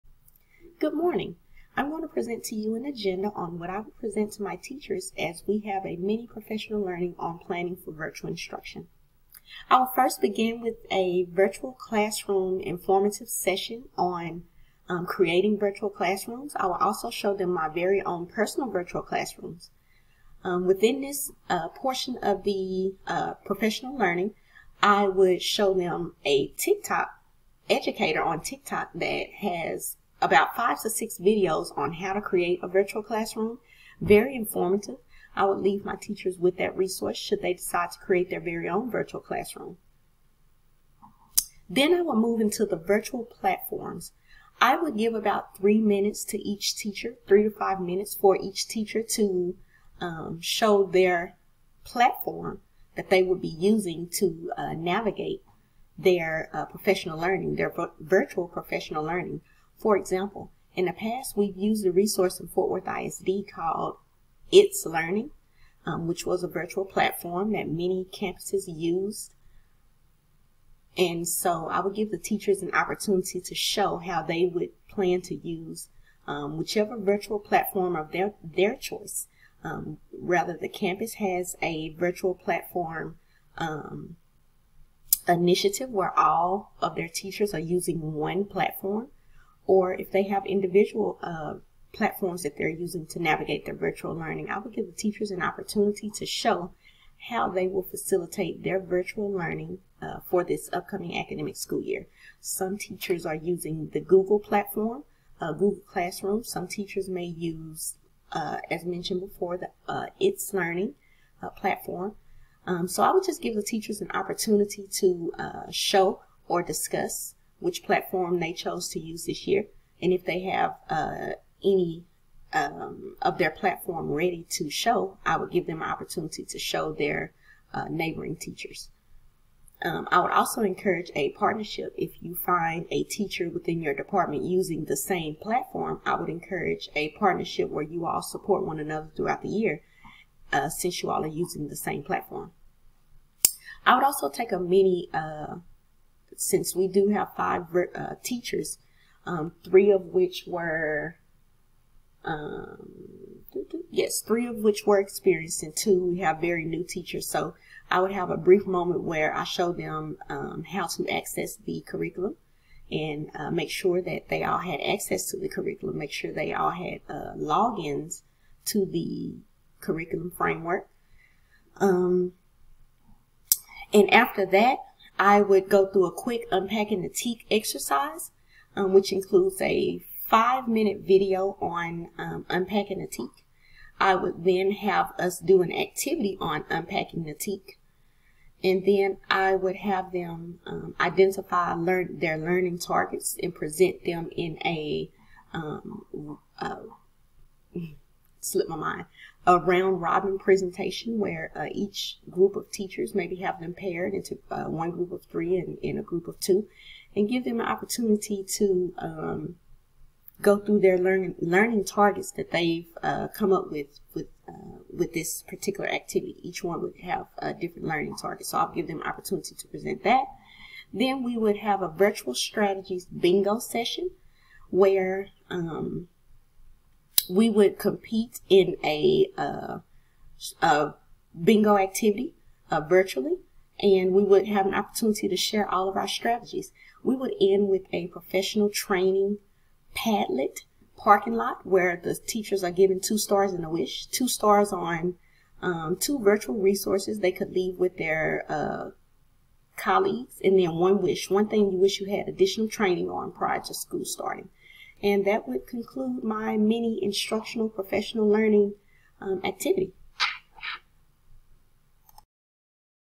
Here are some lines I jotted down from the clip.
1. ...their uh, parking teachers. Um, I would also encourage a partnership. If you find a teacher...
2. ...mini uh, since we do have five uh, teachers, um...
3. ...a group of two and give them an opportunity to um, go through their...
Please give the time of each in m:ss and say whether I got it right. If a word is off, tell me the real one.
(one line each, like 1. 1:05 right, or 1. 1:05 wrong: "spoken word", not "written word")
1. 2:06 wrong: "neighboring", not "parking"
2. 2:24 right
3. 3:25 right.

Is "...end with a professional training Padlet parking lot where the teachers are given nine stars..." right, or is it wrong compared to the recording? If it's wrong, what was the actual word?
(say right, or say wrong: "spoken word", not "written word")
wrong: "two", not "nine".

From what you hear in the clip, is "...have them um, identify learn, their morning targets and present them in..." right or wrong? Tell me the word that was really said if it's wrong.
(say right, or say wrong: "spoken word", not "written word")
wrong: "learning", not "morning".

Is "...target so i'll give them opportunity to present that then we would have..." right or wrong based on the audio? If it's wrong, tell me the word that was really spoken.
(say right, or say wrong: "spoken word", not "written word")
right.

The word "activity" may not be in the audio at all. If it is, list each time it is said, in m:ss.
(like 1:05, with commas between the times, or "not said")
3:05, 3:35, 3:51, 4:19.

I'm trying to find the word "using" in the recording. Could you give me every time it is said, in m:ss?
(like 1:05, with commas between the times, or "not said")
0:53, 1:27, 1:32, 1:43, 2:14, 2:21.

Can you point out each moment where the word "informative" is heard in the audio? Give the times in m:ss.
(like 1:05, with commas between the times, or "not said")
0:12, 0:34.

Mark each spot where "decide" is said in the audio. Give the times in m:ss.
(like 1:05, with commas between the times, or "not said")
0:37.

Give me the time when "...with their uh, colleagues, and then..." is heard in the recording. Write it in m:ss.
4:07.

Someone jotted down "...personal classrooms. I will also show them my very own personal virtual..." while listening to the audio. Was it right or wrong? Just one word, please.
wrong.